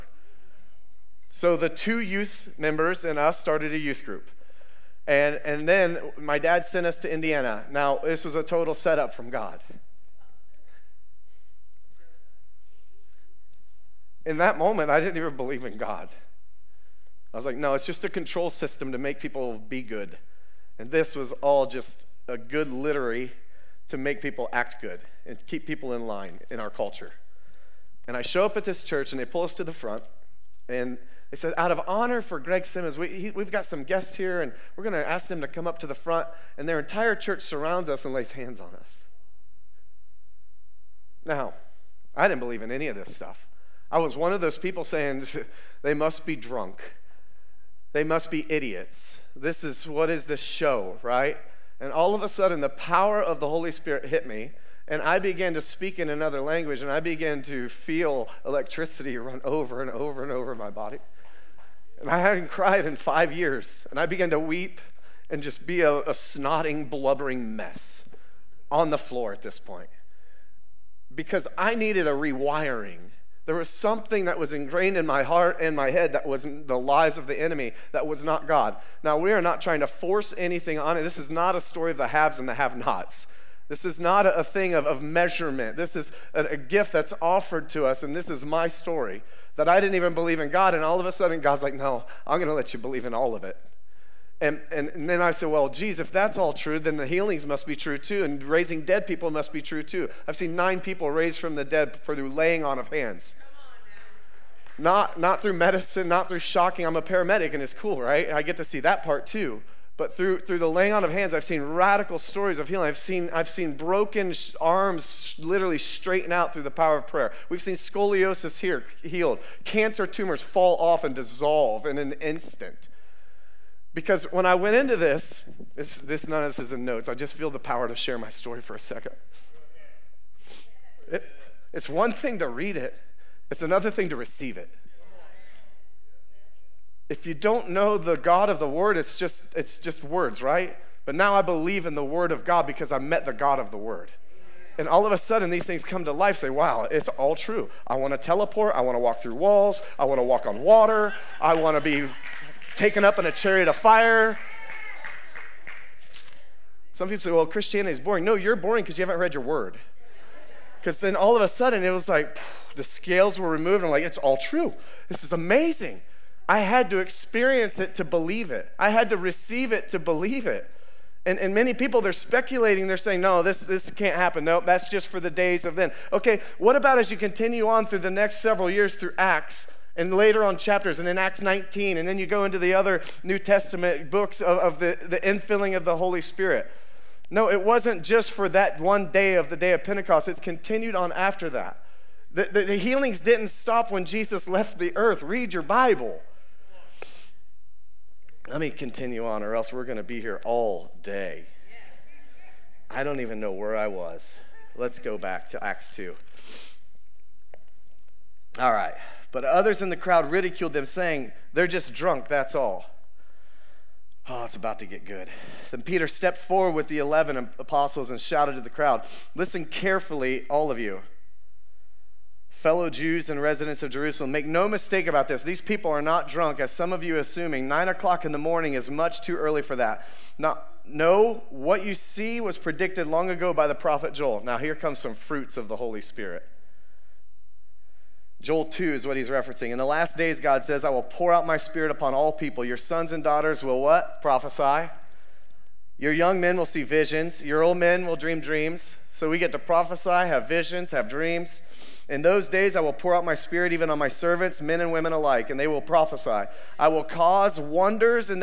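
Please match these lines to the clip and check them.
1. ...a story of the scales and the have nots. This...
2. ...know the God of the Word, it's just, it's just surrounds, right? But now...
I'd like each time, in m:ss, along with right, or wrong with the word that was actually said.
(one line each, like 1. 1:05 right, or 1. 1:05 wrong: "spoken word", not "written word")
1. 1:21 wrong: "haves", not "scales"
2. 2:17 wrong: "words", not "surrounds".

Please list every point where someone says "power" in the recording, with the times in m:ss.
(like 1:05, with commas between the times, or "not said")
0:52, 1:56, 2:07.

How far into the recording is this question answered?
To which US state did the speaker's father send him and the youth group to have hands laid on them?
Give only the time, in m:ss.
0:07.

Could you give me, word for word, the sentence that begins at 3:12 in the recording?
the, the, the healings didn't stop when Jesus left the earth.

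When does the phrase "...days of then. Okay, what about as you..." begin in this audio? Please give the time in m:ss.
2:55.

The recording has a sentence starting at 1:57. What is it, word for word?
We've seen scoliosis here healed, cancer tumors fall off and dissolve in an instant.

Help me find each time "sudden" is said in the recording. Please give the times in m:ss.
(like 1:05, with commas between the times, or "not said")
0:52, 1:31, 2:25, 2:41.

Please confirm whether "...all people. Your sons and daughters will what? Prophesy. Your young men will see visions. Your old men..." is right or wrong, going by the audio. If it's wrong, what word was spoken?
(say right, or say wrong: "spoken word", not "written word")
right.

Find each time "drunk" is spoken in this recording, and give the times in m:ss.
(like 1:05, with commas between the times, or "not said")
0:46, 3:31, 3:46.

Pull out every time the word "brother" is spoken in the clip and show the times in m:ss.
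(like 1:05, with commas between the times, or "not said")
not said.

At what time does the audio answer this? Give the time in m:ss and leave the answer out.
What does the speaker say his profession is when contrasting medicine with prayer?
1:47.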